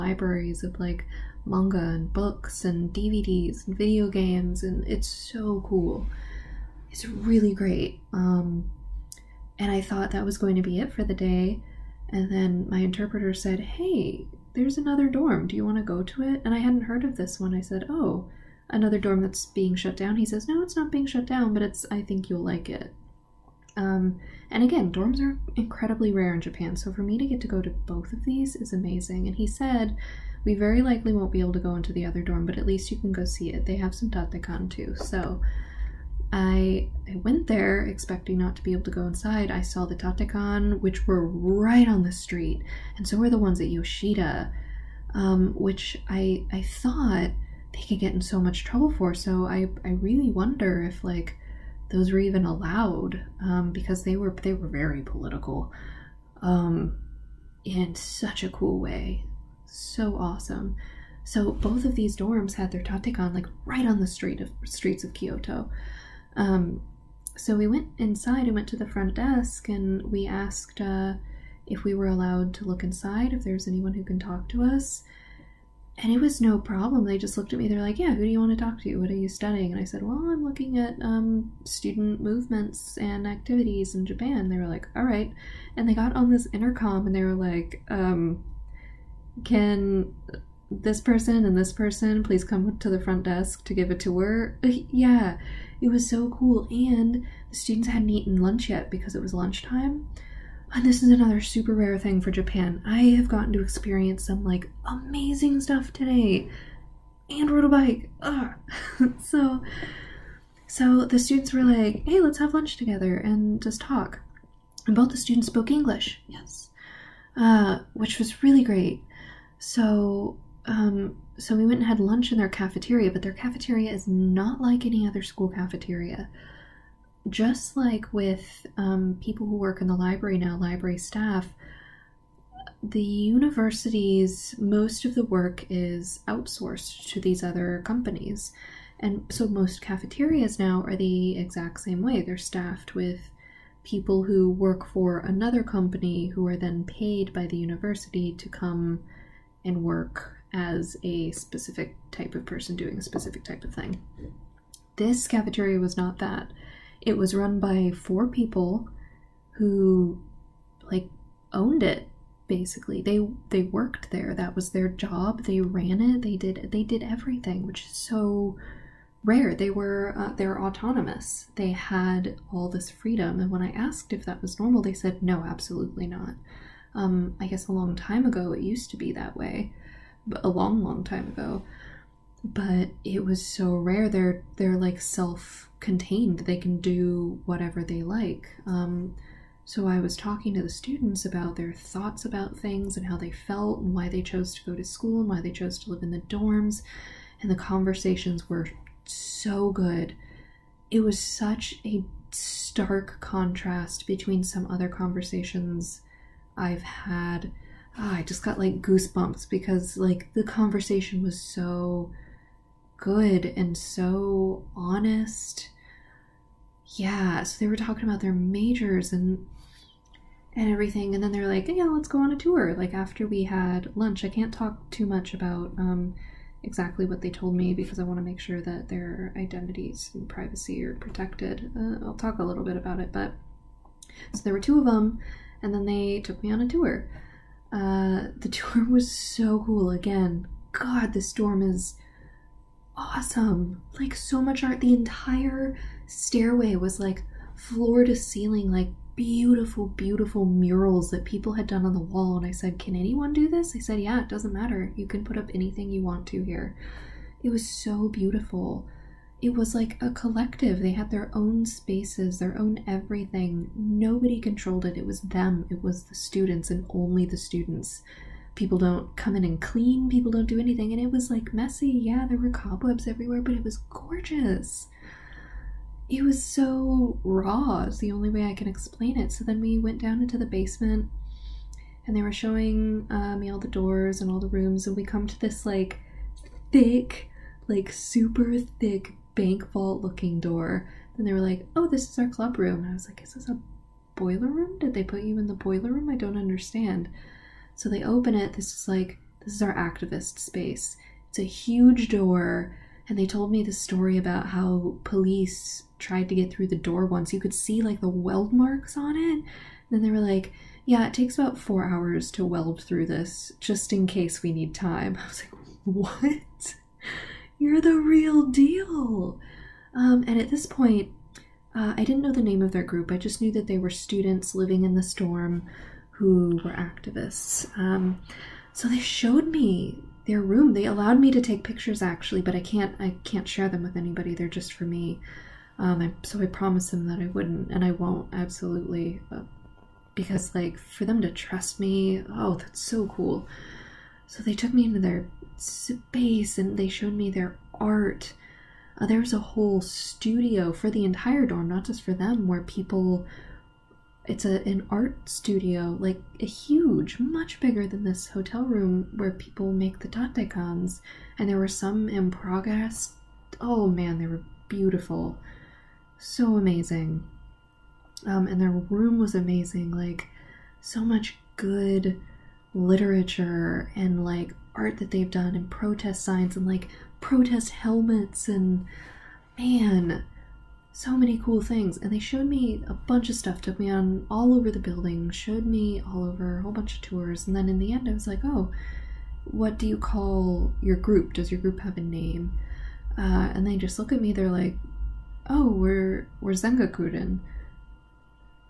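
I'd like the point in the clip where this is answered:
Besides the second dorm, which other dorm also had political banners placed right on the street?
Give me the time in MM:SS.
00:43.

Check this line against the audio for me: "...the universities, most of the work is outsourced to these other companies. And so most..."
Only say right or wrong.
right.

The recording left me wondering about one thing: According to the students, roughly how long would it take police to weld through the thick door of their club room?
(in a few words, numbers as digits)
4 hours.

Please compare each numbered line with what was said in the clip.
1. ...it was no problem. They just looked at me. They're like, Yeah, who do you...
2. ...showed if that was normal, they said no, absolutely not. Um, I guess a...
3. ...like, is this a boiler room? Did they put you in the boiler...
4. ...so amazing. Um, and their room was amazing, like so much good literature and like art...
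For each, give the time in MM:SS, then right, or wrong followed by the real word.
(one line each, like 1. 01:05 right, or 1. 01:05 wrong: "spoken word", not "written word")
1. 01:16 right
2. 02:53 wrong: "asked", not "showed"
3. 04:53 right
4. 06:06 right.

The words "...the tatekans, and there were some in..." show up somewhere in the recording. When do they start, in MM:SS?
05:59.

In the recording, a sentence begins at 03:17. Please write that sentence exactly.
And the conversations were so good.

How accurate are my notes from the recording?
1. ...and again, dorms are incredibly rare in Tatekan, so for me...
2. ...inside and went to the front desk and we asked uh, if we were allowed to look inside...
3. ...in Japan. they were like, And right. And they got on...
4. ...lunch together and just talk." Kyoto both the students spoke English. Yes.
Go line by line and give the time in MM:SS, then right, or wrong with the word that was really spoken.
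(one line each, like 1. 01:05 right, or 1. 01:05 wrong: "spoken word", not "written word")
1. 00:24 wrong: "Japan", not "Tatekan"
2. 01:07 right
3. 01:23 wrong: "All", not "And"
4. 01:52 wrong: "And", not "Kyoto".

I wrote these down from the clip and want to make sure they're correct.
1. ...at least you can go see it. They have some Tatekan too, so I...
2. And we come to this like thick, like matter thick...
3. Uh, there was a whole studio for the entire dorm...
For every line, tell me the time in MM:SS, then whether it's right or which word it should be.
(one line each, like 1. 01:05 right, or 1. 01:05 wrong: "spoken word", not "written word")
1. 00:32 right
2. 04:44 wrong: "super", not "matter"
3. 05:48 right.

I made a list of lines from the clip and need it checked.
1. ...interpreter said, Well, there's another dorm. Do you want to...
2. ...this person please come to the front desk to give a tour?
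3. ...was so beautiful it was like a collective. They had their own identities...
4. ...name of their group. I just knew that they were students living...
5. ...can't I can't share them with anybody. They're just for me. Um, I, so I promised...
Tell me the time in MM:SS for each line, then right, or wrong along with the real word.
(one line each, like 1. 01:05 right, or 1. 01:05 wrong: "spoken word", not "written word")
1. 00:12 wrong: "Hey", not "Well"
2. 01:31 right
3. 04:17 wrong: "spaces", not "identities"
4. 05:22 right
5. 05:32 right.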